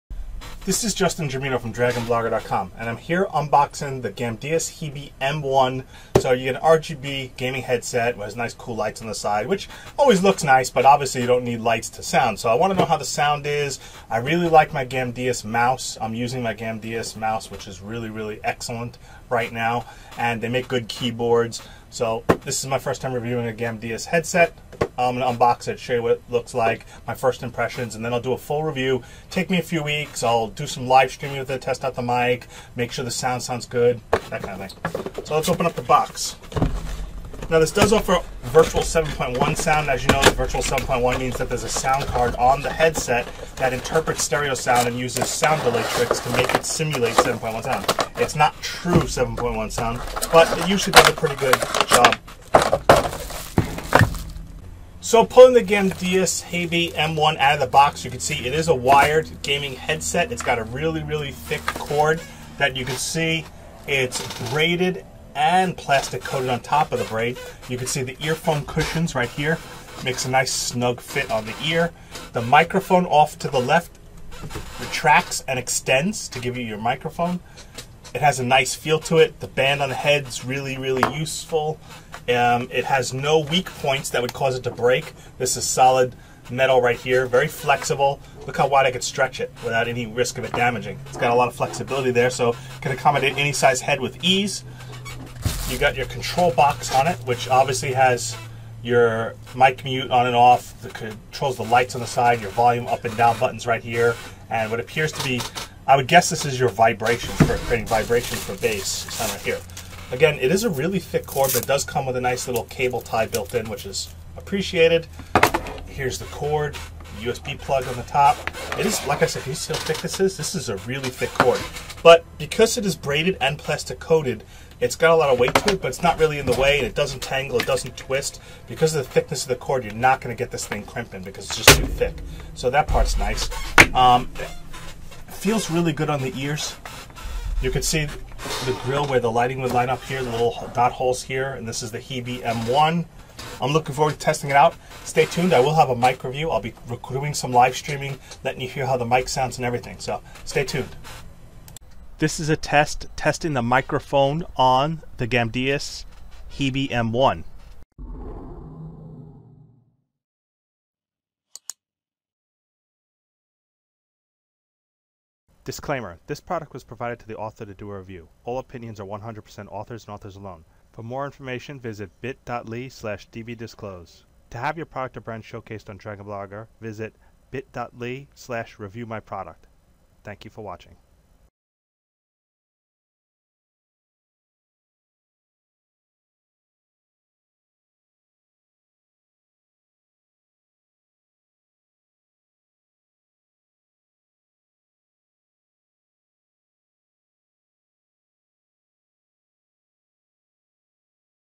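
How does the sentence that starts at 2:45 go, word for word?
Disclaimer This product was provided to the author to do a review.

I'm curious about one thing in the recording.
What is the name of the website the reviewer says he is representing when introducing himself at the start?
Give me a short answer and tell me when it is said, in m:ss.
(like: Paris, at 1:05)
DragonBlogger.com, at 0:01.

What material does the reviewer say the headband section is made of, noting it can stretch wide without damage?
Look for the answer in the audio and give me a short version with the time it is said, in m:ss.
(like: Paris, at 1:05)
solid metal, at 1:25.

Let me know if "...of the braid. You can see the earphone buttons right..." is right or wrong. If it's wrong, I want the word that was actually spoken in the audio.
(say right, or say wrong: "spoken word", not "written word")
wrong: "cushions", not "buttons".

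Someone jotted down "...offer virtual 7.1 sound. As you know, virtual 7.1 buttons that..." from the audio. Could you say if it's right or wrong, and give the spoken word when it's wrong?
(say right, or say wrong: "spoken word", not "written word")
wrong: "means", not "buttons".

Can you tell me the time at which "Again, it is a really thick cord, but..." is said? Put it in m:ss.
1:50.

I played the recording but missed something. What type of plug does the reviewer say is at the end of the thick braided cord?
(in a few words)
USB.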